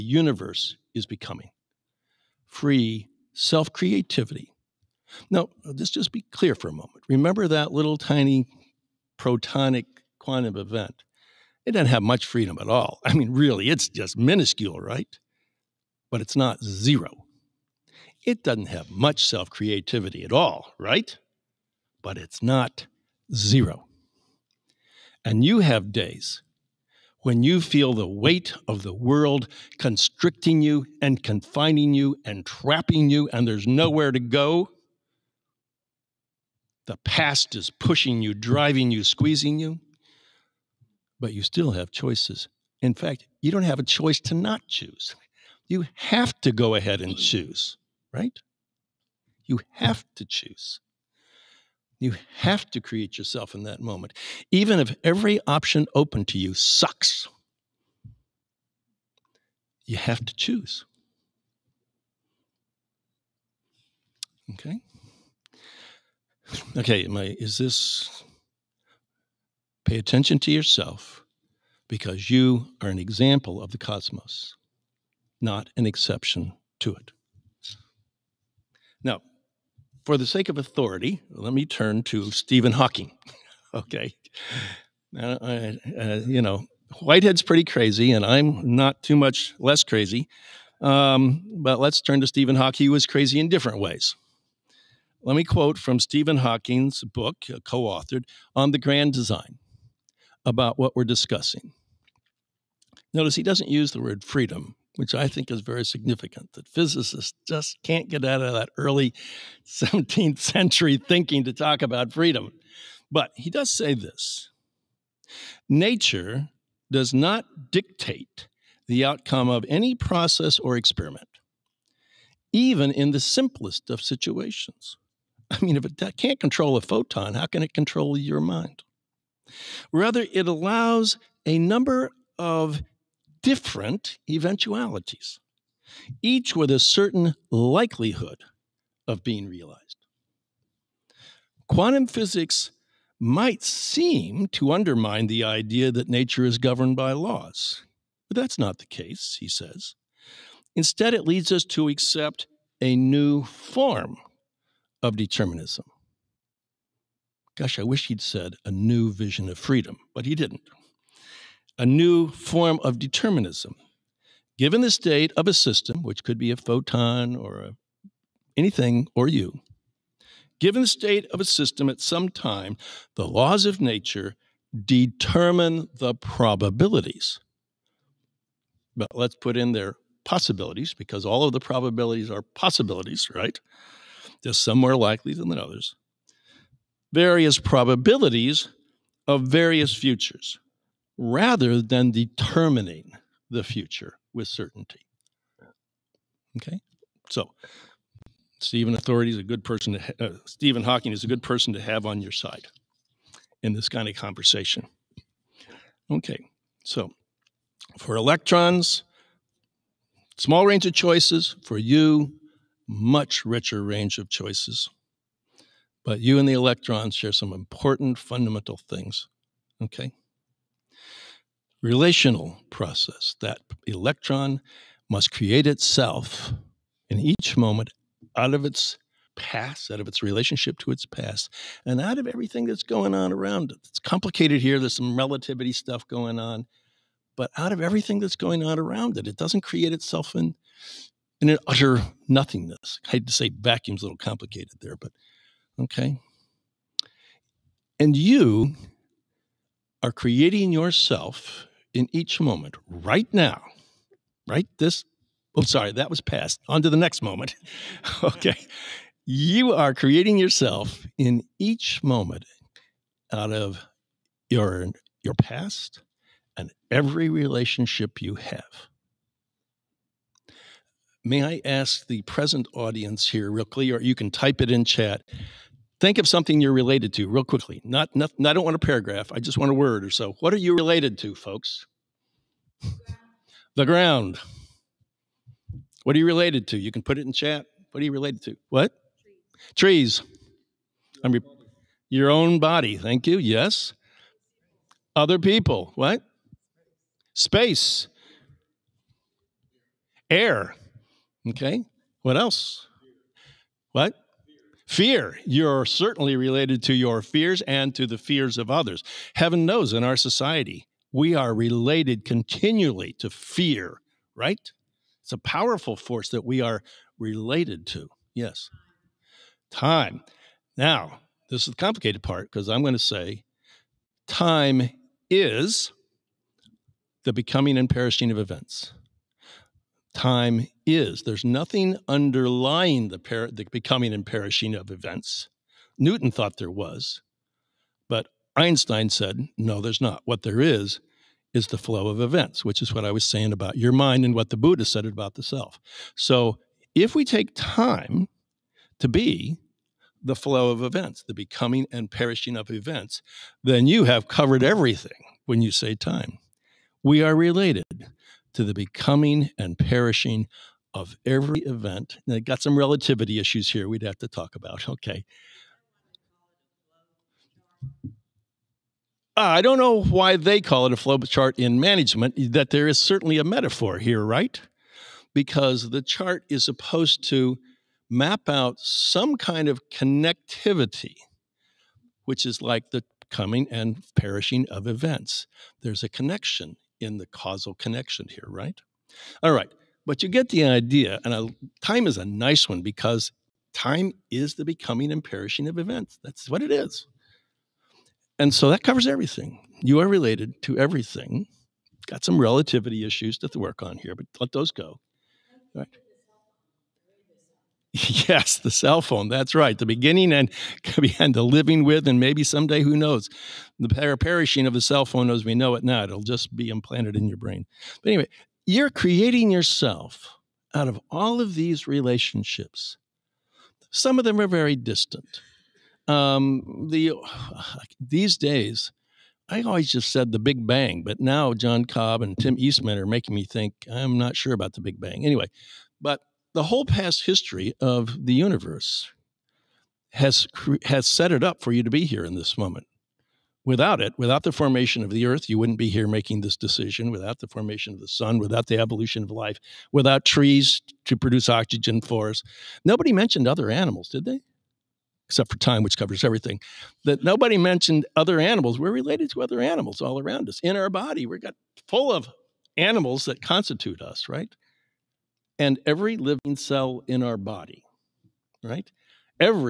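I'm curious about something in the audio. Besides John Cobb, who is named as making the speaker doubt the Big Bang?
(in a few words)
Tim Eastman.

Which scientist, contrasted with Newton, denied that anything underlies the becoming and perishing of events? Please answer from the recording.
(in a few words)
Einstein.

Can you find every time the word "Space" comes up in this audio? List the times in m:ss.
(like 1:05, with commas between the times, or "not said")
4:57.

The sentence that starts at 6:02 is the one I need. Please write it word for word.
And I got some relativity issues here we'd have to talk about.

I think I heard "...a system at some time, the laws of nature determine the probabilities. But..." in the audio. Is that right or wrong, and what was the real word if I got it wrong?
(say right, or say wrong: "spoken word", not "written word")
right.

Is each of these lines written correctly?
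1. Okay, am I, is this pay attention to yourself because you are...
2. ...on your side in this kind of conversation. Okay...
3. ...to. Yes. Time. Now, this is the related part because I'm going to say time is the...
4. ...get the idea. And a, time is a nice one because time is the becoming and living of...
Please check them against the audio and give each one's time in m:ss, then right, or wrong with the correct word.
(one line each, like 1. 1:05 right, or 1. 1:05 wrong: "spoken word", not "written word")
1. 1:06 right
2. 3:22 right
3. 5:17 wrong: "complicated", not "related"
4. 6:30 wrong: "perishing", not "living".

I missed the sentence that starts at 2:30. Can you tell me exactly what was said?
Instead, it leads us to accept a new form of determinism.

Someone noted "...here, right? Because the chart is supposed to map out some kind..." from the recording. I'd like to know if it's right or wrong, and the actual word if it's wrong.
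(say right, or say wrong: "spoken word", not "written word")
right.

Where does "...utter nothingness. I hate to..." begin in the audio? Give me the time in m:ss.
4:01.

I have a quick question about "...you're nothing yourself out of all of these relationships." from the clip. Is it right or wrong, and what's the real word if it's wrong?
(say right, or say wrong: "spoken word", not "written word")
wrong: "creating", not "nothing".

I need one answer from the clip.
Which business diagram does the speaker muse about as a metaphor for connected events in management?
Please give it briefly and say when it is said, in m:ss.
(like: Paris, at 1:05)
flow chart, at 6:10.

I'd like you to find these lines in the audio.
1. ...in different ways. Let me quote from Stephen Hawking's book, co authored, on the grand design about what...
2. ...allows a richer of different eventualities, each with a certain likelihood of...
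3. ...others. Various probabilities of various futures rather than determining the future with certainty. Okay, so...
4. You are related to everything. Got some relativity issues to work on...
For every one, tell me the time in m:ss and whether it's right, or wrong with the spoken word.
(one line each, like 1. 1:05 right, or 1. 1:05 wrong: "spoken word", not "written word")
1. 1:33 right
2. 2:10 wrong: "number", not "richer"
3. 3:05 right
4. 6:39 right.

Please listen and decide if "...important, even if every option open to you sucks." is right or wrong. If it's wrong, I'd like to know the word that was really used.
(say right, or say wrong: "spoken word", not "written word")
wrong: "moment", not "important".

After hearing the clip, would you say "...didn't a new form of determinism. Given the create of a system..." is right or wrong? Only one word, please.
wrong.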